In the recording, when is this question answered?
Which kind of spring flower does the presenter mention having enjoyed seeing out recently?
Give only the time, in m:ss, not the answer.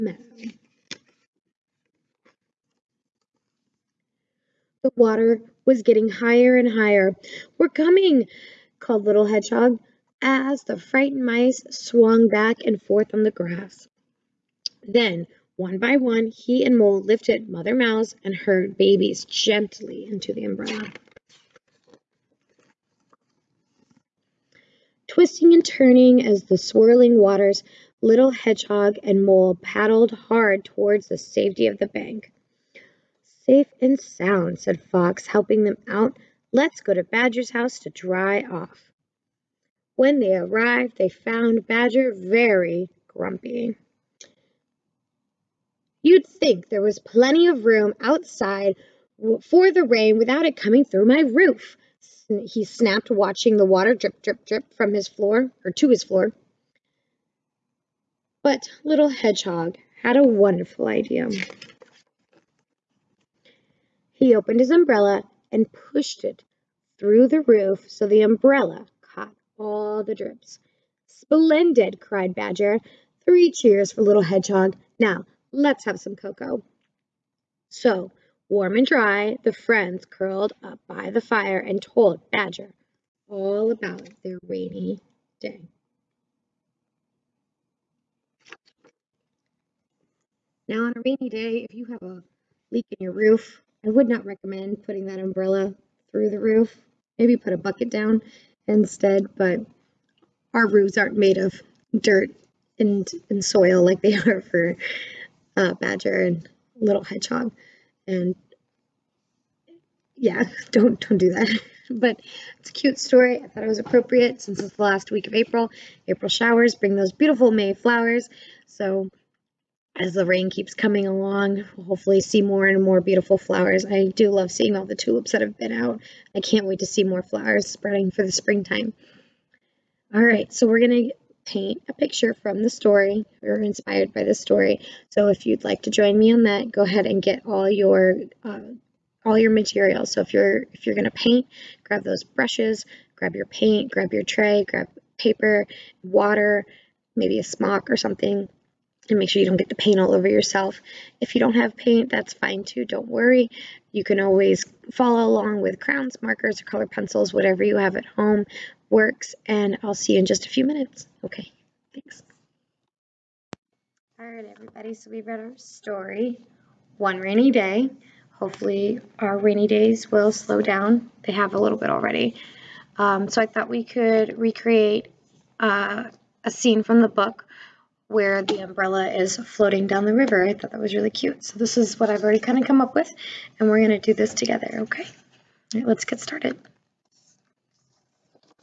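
2:04.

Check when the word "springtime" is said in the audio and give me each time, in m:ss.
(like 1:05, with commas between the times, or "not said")
2:08.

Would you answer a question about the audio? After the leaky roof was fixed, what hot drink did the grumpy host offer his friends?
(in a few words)
cocoa.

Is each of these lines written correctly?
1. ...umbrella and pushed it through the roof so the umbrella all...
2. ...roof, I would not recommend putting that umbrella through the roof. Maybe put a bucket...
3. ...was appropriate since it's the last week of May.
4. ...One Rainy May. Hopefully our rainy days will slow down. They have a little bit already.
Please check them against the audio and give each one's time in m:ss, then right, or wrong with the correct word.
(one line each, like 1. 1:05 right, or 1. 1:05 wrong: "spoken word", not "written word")
1. 1:04 right
2. 1:33 right
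3. 1:53 wrong: "April", not "May"
4. 2:46 wrong: "Day", not "May".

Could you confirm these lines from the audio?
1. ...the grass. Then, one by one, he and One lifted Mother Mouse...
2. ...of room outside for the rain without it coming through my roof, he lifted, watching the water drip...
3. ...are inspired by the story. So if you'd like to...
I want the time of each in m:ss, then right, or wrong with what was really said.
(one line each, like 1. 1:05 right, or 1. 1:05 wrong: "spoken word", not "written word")
1. 0:13 wrong: "Mole", not "One"
2. 0:47 wrong: "snapped", not "lifted"
3. 2:13 right.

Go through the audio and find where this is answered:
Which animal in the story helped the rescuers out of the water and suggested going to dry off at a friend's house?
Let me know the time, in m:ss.
0:34.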